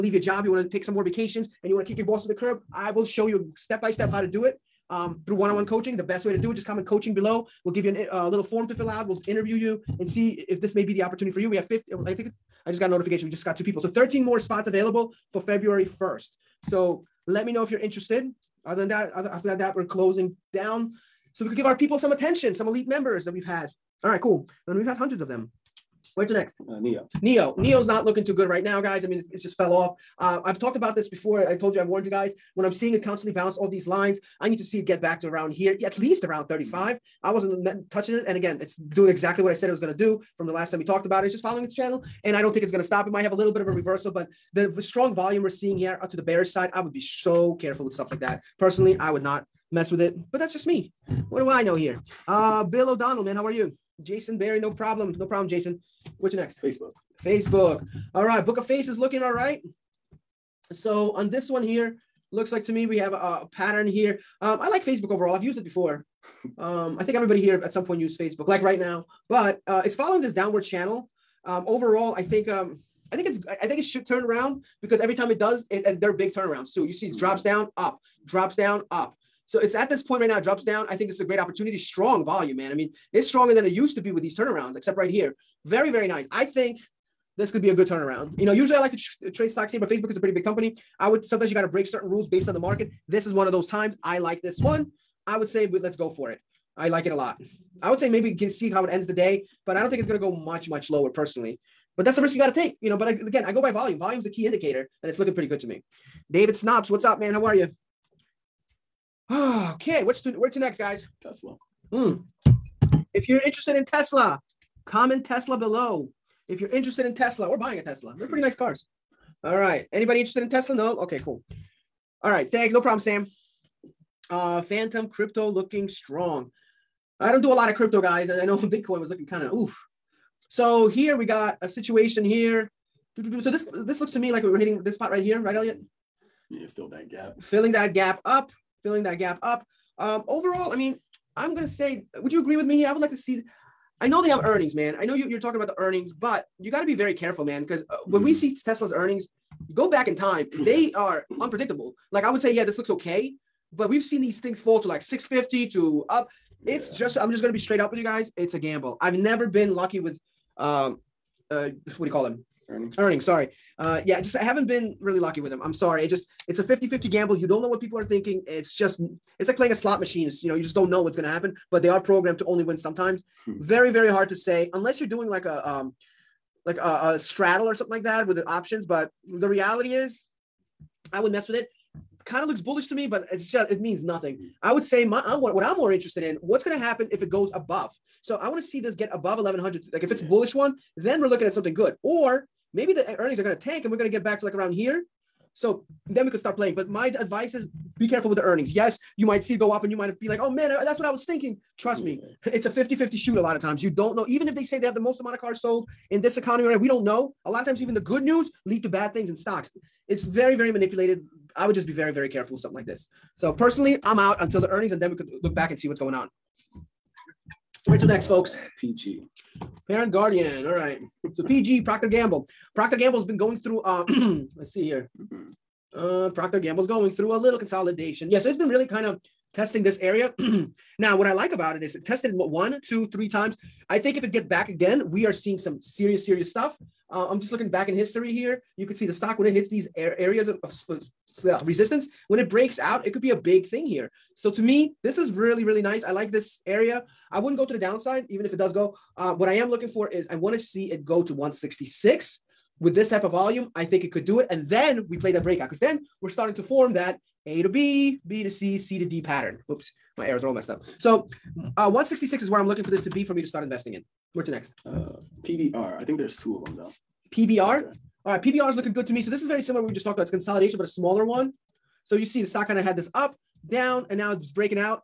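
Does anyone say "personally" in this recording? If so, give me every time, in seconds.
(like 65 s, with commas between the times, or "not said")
48 s, 101 s, 213 s.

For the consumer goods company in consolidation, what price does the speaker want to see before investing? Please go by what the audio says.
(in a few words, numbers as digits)
166.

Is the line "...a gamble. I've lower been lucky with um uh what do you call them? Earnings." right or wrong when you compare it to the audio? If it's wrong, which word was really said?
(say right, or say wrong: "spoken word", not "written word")
wrong: "never", not "lower".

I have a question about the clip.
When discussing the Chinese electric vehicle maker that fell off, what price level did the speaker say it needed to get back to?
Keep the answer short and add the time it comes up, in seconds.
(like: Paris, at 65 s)
35, at 36 s.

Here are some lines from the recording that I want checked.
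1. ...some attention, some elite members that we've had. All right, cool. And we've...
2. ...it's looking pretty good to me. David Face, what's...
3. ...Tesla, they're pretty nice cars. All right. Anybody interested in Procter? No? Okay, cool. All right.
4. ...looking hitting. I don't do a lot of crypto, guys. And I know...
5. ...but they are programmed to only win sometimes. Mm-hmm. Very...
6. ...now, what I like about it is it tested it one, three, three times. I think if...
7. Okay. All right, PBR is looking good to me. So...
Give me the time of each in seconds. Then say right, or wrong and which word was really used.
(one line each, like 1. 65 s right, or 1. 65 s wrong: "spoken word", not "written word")
1. 21 s right
2. 105 s wrong: "Snops", not "Face"
3. 117 s wrong: "Tesla", not "Procter"
4. 125 s wrong: "strong", not "hitting"
5. 171 s right
6. 231 s wrong: "two", not "three"
7. 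267 s right.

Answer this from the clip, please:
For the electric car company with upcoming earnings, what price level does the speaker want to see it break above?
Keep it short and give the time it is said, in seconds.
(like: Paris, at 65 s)
1100, at 189 s.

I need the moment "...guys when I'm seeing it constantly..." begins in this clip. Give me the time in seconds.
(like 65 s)
32 s.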